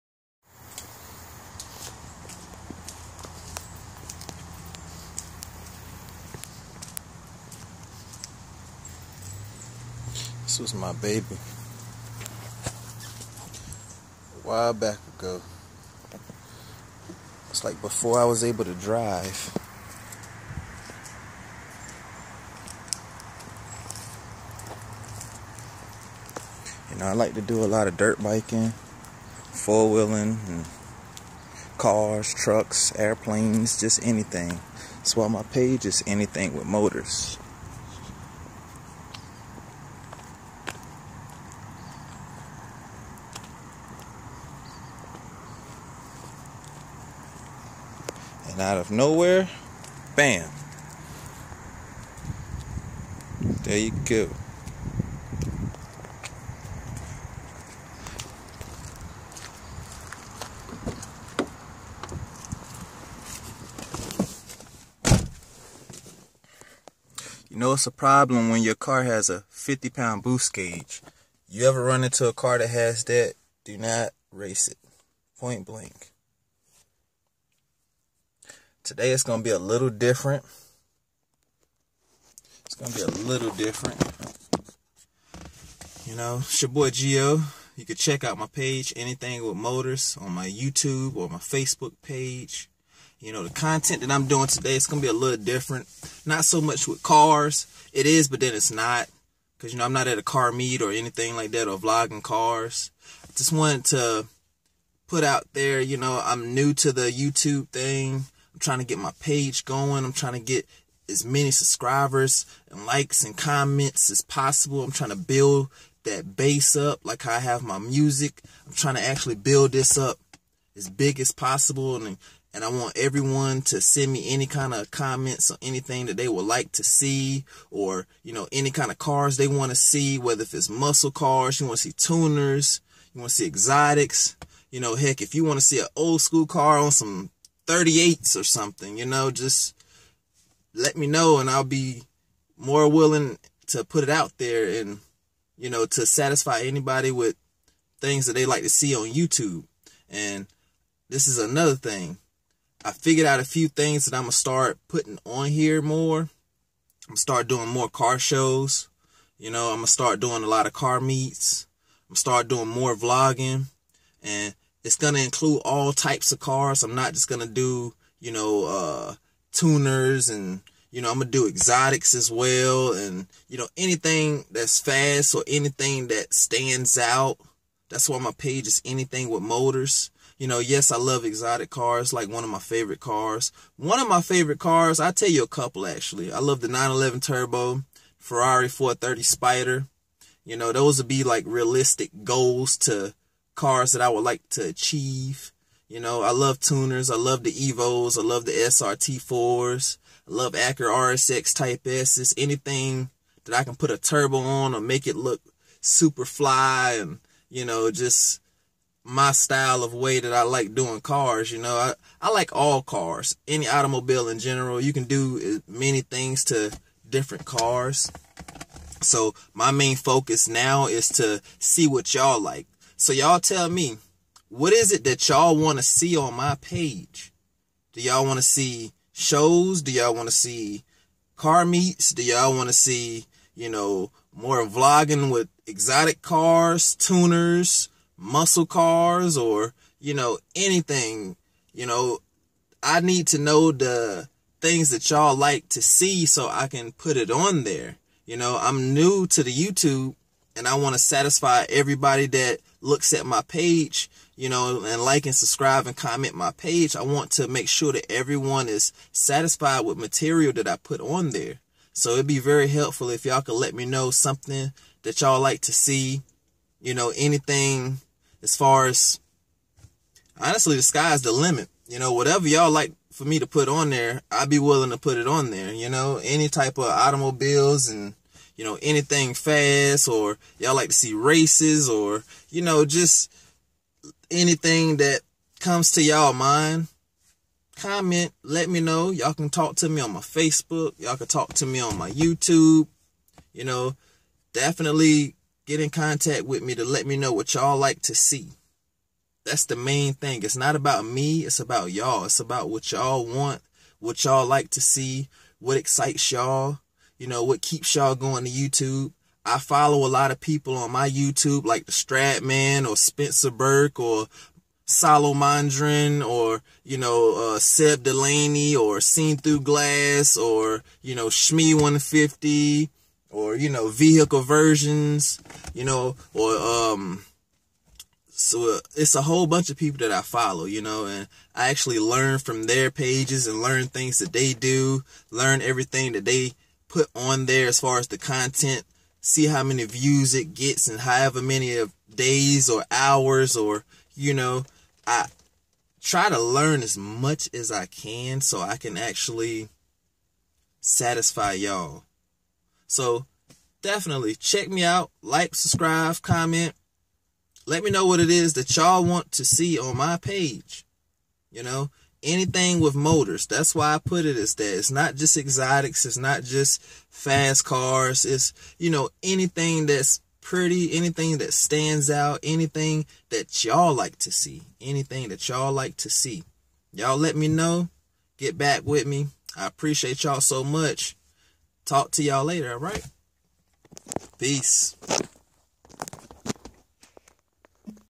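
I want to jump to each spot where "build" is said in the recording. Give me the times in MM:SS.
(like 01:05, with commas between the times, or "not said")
01:55, 01:59.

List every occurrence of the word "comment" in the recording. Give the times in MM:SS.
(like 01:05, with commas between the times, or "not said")
01:53, 02:04, 04:15, 04:47, 05:56.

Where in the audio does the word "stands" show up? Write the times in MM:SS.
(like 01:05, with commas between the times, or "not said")
02:56, 06:11.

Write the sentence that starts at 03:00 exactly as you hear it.
You know, yes, I love exotic cars, like one of my favorite cars.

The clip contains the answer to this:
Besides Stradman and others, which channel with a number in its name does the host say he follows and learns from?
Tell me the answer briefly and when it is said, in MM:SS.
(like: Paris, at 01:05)
Shmee150, at 05:21.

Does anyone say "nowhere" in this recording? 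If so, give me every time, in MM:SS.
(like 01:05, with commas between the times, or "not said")
00:48.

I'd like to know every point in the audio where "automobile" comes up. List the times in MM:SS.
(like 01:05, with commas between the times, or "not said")
03:33, 04:36.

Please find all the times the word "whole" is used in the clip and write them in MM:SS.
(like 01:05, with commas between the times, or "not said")
05:29.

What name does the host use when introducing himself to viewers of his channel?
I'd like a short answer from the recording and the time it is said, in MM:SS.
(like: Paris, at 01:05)
Geo, at 01:26.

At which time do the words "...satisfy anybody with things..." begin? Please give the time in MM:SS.
02:26.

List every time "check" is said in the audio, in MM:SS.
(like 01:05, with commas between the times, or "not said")
01:27, 05:54.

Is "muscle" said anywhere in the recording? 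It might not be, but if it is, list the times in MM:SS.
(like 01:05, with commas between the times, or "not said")
02:10, 03:58.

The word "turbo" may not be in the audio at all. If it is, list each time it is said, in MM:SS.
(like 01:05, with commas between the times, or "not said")
03:07, 03:23.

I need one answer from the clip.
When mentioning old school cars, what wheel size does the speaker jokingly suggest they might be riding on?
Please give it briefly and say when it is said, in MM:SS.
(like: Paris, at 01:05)
38s, at 02:17.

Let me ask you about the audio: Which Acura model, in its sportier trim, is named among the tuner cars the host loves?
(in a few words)
Acura RSX Type S.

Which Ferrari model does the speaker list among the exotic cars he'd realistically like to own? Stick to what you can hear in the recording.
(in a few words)
Ferrari 430 Spider.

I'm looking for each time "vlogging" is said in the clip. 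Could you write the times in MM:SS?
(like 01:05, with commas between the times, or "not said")
01:41, 02:42, 03:54.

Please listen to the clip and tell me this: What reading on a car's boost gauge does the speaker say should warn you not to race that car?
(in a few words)
50 pound.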